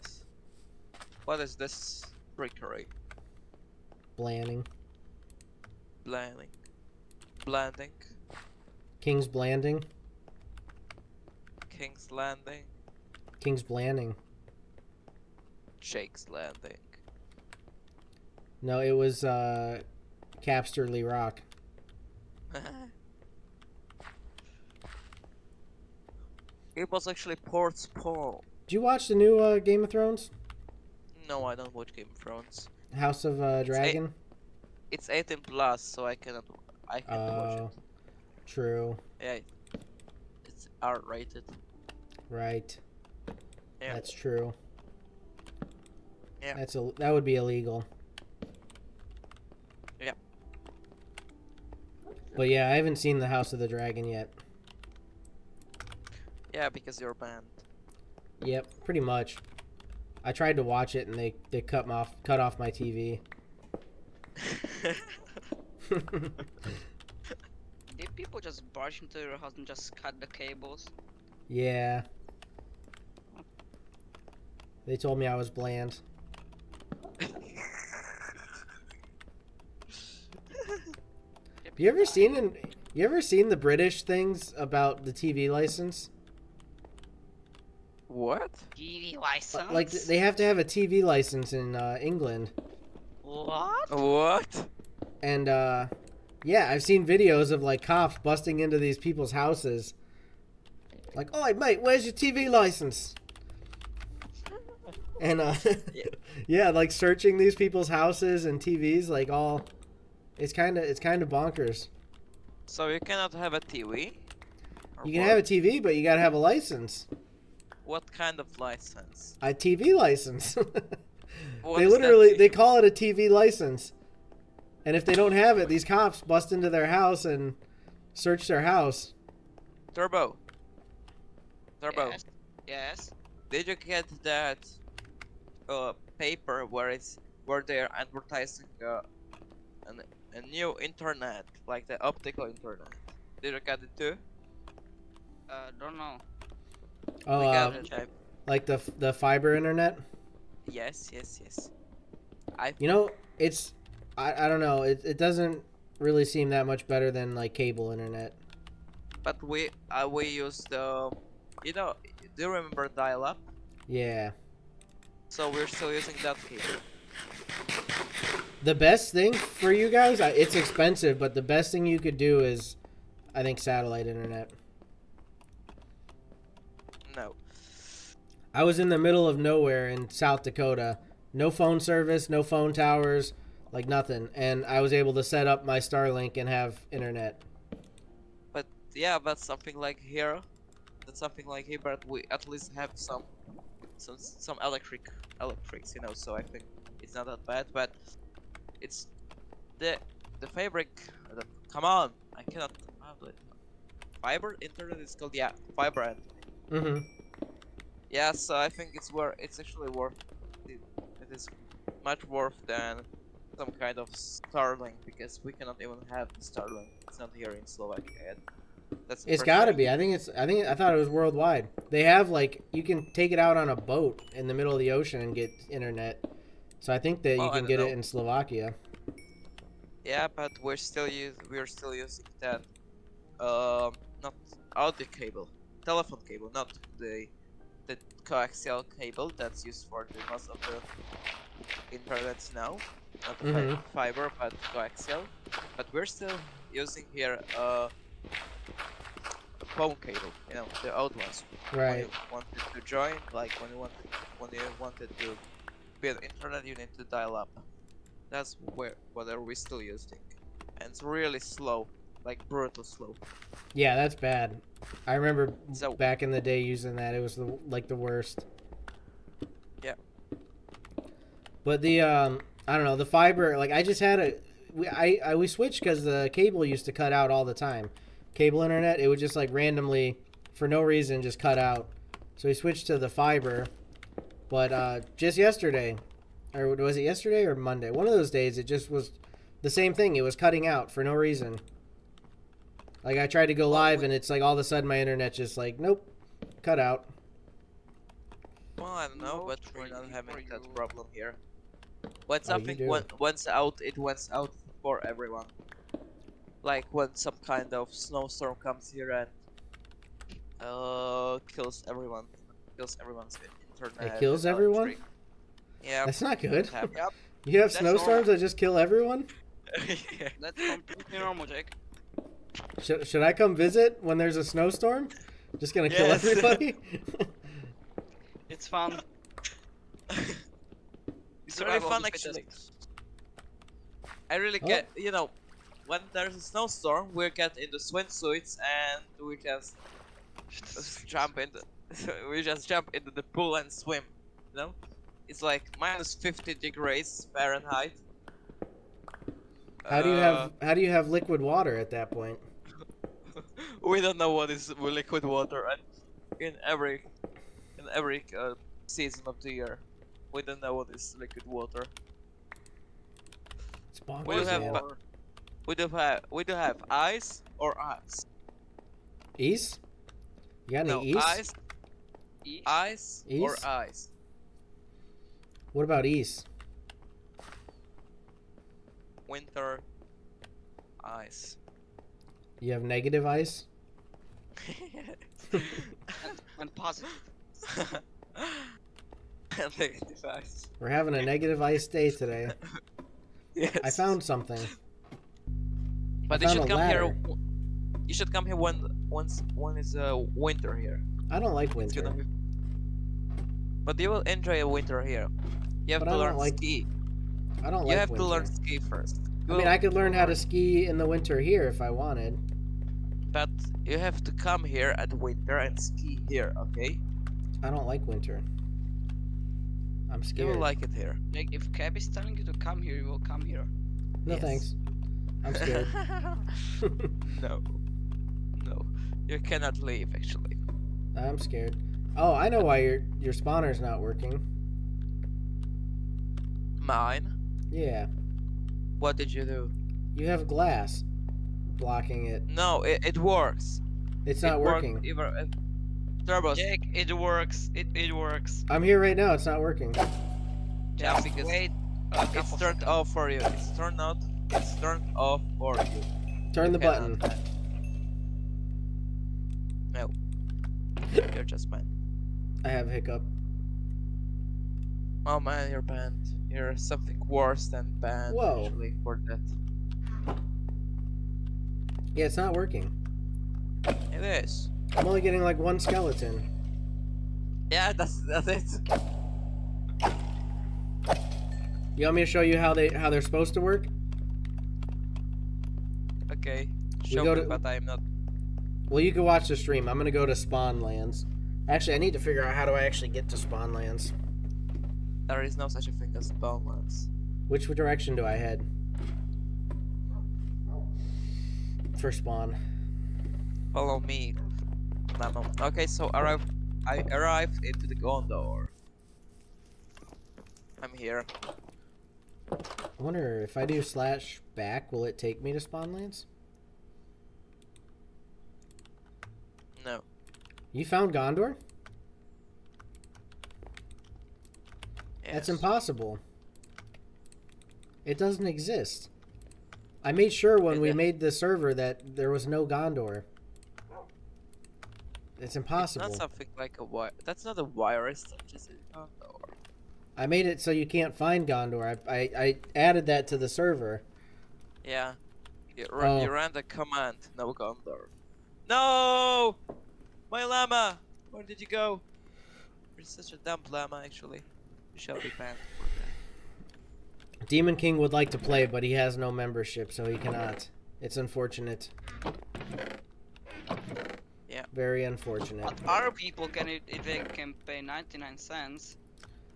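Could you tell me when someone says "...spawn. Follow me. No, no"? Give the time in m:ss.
8:22.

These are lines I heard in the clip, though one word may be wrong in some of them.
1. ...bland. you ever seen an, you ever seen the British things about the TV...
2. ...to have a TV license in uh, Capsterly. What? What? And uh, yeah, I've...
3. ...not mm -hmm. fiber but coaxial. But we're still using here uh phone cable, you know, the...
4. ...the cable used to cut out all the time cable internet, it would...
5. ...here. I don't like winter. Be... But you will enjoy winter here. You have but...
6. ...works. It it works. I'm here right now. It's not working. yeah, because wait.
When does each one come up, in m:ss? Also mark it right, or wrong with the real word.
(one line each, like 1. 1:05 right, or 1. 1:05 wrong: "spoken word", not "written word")
1. 1:15 right
2. 1:30 wrong: "England", not "Capsterly"
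3. 4:03 right
4. 4:36 right
5. 6:40 right
6. 7:27 right.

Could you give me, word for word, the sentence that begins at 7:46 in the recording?
You're something worse than banned Whoa.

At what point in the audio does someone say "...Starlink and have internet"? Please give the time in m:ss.
3:05.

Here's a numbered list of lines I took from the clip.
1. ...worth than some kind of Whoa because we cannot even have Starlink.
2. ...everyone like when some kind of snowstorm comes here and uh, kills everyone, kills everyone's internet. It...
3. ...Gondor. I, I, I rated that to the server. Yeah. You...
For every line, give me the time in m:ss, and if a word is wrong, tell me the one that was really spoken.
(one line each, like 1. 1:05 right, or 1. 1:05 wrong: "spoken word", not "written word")
1. 3:32 wrong: "Starlink", not "Whoa"
2. 5:05 right
3. 9:01 wrong: "added", not "rated".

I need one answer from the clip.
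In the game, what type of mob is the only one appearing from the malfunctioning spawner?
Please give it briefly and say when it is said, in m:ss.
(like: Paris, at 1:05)
skeleton, at 7:55.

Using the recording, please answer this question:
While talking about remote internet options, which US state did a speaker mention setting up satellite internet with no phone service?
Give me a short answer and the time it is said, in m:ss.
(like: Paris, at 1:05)
South Dakota, at 3:00.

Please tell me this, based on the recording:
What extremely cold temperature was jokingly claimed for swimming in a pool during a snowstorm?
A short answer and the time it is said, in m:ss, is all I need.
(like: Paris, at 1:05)
minus 50 degrees Fahrenheit, at 5:45.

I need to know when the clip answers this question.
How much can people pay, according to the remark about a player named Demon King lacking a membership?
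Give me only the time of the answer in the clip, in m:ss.
9:27.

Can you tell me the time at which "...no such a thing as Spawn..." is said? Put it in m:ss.
8:15.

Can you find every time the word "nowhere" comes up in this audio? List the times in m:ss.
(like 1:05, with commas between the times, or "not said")
2:59.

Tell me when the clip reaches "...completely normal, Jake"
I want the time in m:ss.
5:20.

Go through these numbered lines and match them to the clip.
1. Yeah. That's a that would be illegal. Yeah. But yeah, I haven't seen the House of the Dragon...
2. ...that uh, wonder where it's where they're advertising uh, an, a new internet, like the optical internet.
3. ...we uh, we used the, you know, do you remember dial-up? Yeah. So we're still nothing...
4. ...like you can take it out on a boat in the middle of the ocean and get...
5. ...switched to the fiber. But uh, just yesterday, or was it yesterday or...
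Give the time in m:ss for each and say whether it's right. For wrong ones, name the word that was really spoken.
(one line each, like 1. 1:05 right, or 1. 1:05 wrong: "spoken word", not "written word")
1. 0:46 right
2. 2:14 wrong: "paper", not "wonder"
3. 2:39 wrong: "using", not "nothing"
4. 3:42 right
5. 4:42 right.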